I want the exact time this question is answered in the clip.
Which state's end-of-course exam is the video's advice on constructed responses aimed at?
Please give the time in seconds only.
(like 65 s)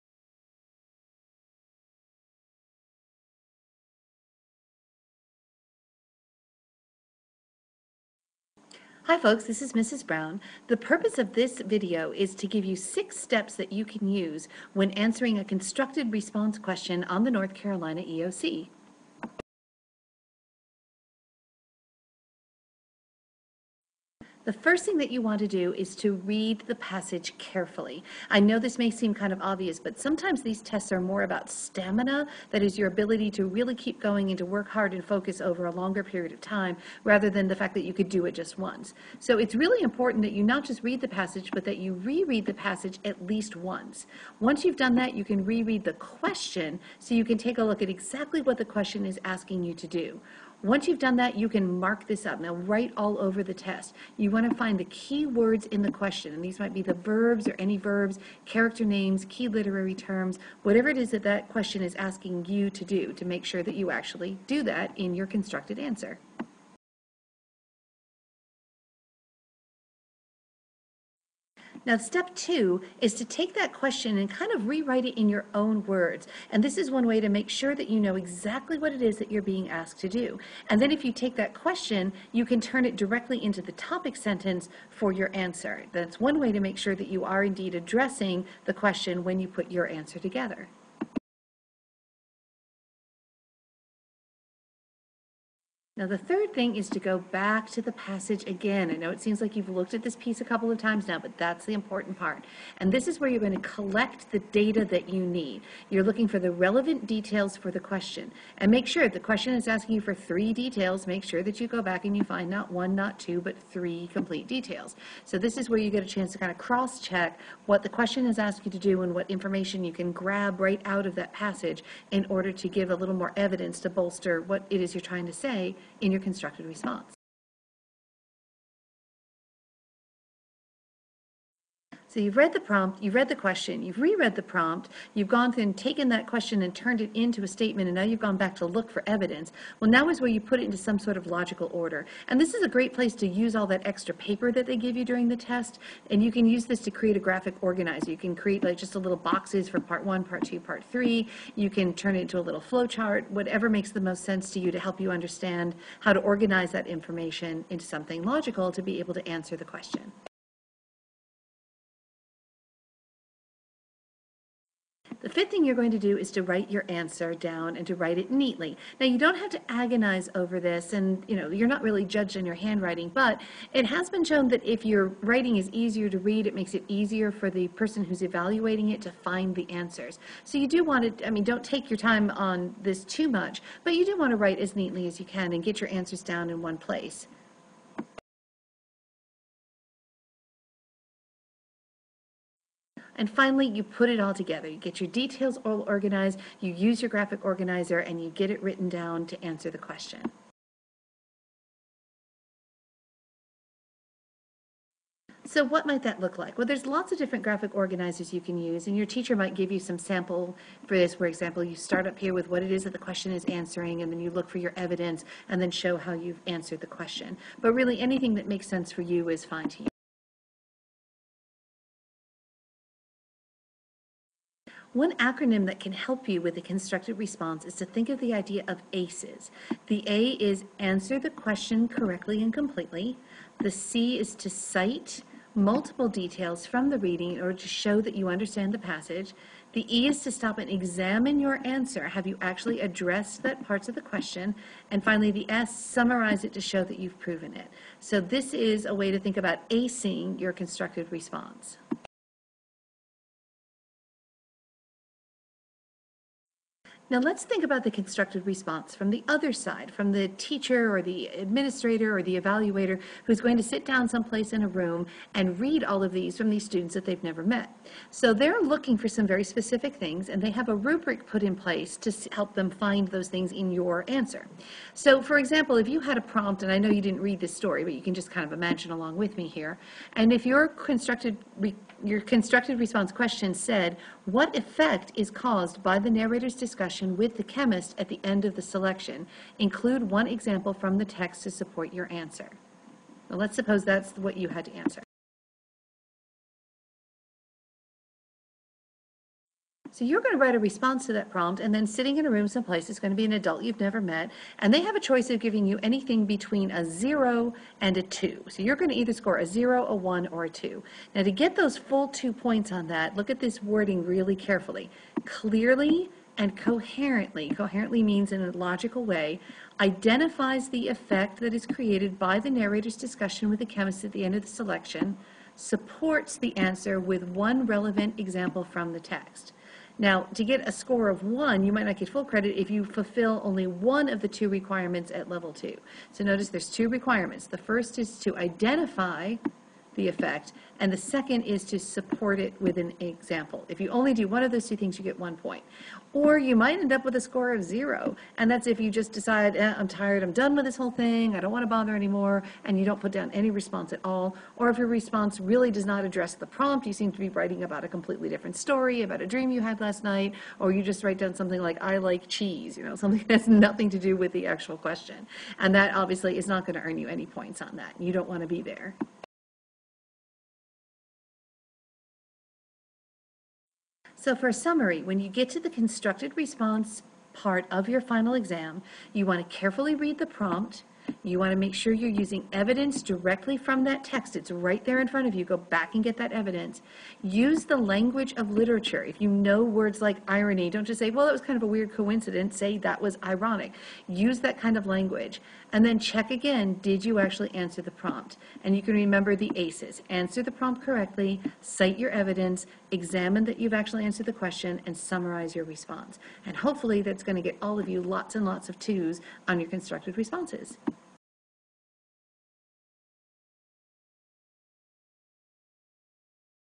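17 s.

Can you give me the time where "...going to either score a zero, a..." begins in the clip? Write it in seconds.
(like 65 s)
308 s.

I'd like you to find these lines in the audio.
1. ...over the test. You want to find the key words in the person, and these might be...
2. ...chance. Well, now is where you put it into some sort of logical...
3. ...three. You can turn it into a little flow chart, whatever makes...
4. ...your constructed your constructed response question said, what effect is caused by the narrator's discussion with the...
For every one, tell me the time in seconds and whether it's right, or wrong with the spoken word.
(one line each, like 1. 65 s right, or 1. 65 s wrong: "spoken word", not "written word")
1. 53 s wrong: "question", not "person"
2. 139 s wrong: "evidence", not "chance"
3. 150 s right
4. 280 s right.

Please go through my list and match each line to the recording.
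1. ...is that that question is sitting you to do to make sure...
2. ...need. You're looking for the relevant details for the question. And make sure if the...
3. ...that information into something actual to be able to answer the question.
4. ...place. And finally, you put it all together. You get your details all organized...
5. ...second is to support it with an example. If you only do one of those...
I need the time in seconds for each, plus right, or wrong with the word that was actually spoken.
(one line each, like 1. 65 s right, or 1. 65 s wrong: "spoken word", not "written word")
1. 60 s wrong: "asking", not "sitting"
2. 105 s right
3. 156 s wrong: "logical", not "actual"
4. 186 s right
5. 340 s right.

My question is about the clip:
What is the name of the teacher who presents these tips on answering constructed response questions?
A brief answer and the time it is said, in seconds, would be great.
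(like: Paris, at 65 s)
Mrs. Brown, at 9 s.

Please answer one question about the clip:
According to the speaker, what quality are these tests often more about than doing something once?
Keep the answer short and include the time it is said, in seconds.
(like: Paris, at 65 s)
Stamina, at 31 s.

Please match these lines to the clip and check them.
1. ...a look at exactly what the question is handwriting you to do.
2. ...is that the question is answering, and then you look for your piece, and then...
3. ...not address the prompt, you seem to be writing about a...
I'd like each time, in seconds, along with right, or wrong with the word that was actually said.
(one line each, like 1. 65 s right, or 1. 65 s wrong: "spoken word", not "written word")
1. 47 s wrong: "asking", not "handwriting"
2. 212 s wrong: "evidence", not "piece"
3. 355 s right.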